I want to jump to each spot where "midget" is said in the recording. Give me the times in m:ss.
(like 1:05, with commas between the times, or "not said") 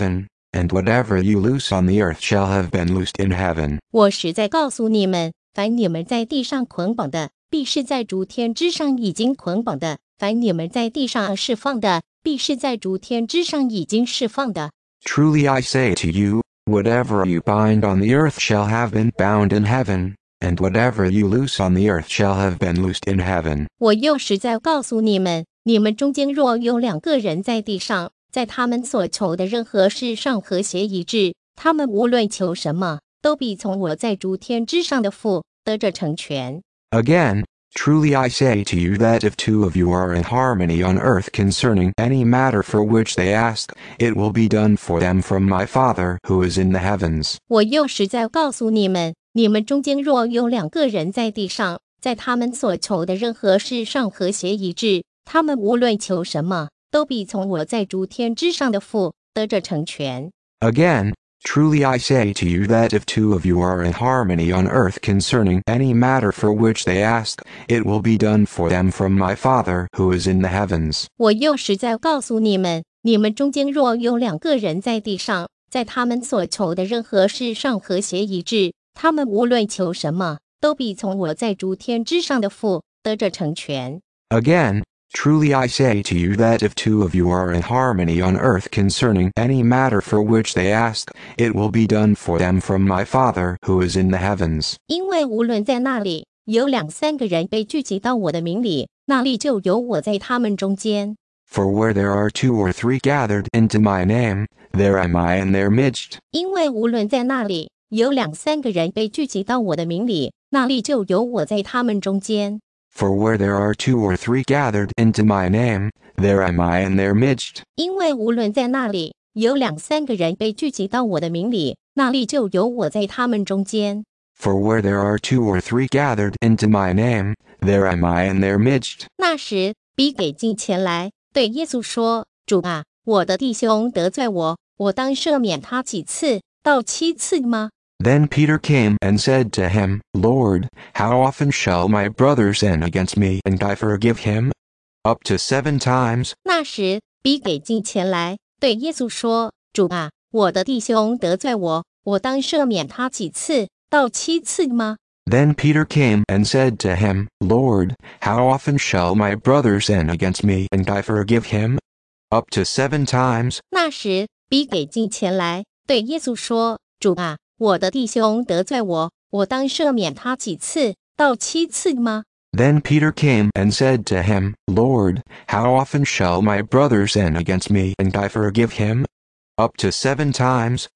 1:57, 2:08.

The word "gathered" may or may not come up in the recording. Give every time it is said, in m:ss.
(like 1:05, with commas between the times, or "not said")
1:42, 1:54, 2:05.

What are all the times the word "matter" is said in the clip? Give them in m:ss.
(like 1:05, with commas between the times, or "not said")
0:42, 1:05, 1:29.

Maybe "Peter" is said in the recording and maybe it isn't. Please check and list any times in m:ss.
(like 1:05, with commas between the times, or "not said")
2:18, 2:35, 2:52.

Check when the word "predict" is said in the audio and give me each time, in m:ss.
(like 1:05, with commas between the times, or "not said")
not said.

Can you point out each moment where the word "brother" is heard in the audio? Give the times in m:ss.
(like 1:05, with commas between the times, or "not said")
2:22, 2:39, 2:56.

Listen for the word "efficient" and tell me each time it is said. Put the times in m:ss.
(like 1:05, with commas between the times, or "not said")
not said.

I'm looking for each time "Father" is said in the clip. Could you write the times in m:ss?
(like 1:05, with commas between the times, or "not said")
0:45, 1:09, 1:33.